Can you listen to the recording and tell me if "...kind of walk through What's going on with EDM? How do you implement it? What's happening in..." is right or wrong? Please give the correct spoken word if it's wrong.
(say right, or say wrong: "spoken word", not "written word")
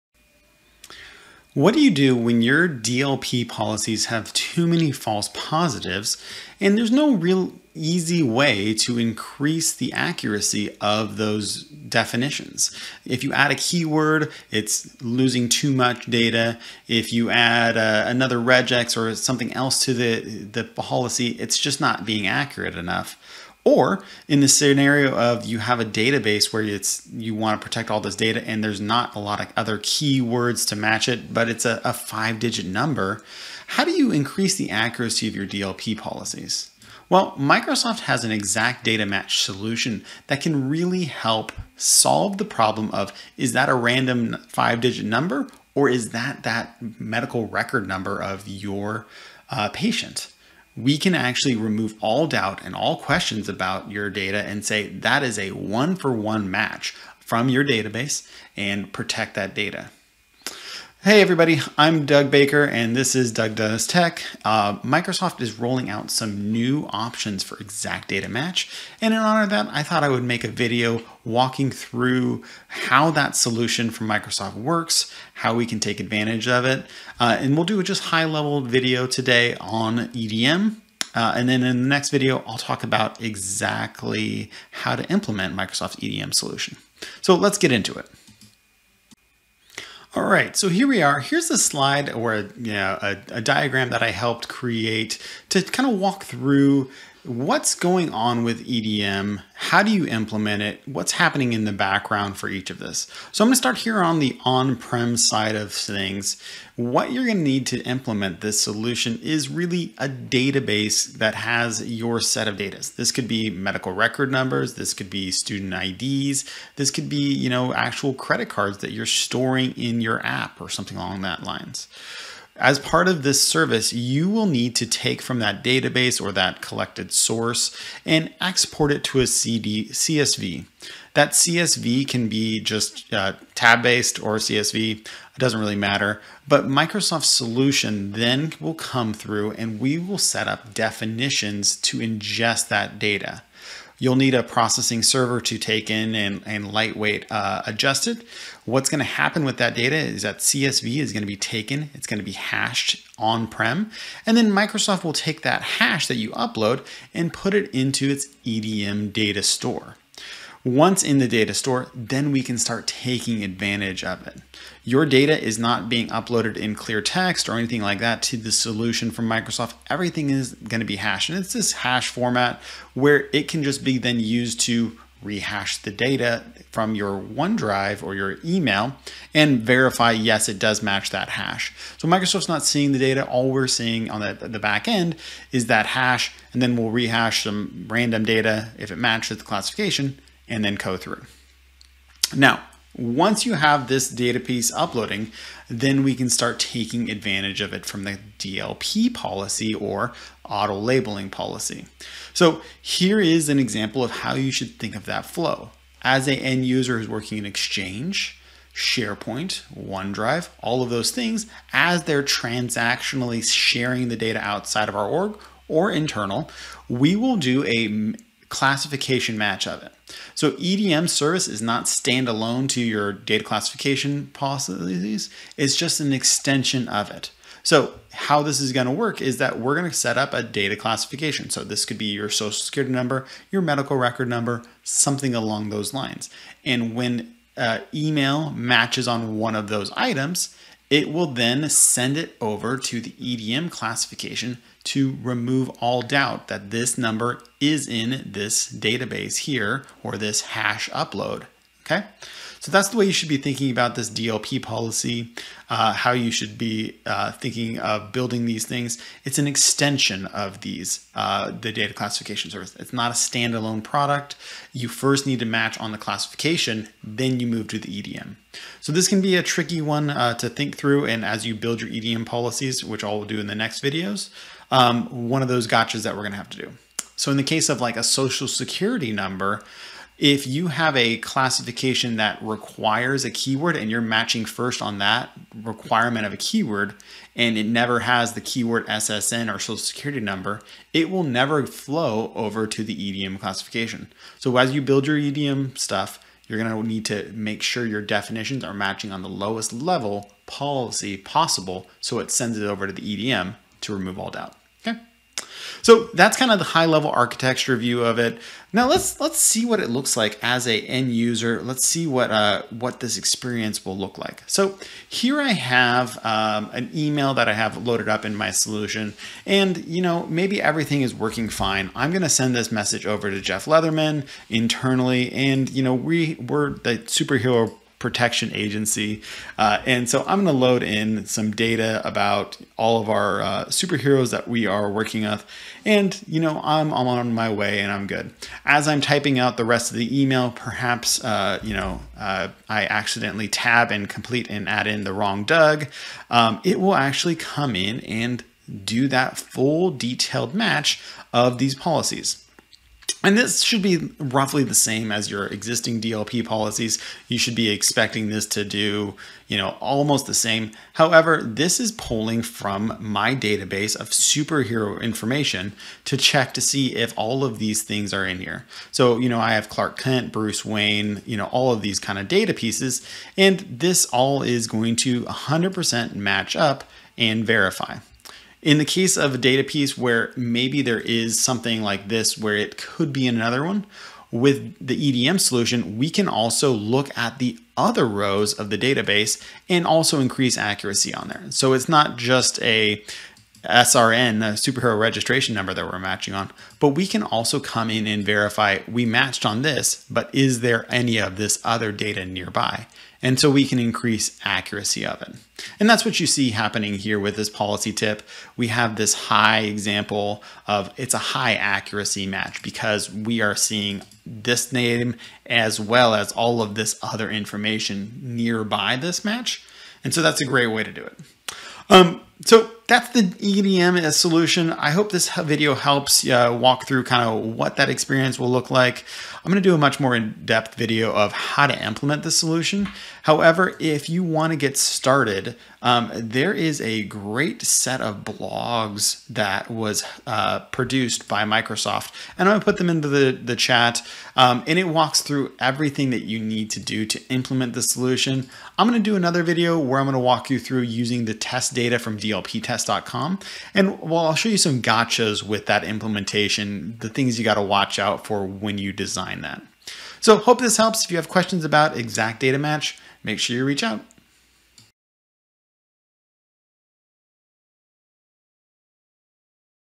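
right.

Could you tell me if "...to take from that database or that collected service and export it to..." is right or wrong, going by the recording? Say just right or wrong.
wrong.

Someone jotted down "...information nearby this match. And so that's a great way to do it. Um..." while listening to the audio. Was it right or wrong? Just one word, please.
right.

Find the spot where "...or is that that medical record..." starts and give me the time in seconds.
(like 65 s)
45 s.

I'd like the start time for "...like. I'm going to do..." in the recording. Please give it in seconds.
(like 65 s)
428 s.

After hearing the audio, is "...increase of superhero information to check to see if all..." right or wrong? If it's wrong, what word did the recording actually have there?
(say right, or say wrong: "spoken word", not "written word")
wrong: "database", not "increase".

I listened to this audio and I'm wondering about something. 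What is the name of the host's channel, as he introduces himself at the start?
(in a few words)
Doug Does Tech.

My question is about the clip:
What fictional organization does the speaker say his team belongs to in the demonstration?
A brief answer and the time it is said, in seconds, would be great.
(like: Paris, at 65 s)
Superhero Protection Agency, at 326 s.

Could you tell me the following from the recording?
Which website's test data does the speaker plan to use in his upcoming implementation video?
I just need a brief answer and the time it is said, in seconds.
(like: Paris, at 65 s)
dlptest.com, at 452 s.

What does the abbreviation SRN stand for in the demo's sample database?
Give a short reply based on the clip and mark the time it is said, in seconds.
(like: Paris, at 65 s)
Superhero registration number, at 394 s.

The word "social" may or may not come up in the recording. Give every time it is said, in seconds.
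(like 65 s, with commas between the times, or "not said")
232 s, 278 s, 289 s.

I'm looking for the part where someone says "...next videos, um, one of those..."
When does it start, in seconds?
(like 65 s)
273 s.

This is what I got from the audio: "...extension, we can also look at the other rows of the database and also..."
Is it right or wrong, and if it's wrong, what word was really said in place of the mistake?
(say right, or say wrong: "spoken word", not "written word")
wrong: "solution", not "extension".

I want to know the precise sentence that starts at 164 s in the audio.
Your data is not being uploaded in clear text or anything like that to the solution from Microsoft.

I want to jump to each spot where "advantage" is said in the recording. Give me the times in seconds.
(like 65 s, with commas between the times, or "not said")
75 s, 163 s, 197 s.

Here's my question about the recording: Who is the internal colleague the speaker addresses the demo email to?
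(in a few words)
Jeff Leatherman.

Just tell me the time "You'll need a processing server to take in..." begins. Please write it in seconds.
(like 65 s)
144 s.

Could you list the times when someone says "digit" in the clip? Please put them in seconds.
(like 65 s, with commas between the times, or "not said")
32 s, 44 s.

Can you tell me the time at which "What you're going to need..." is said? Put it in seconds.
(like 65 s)
106 s.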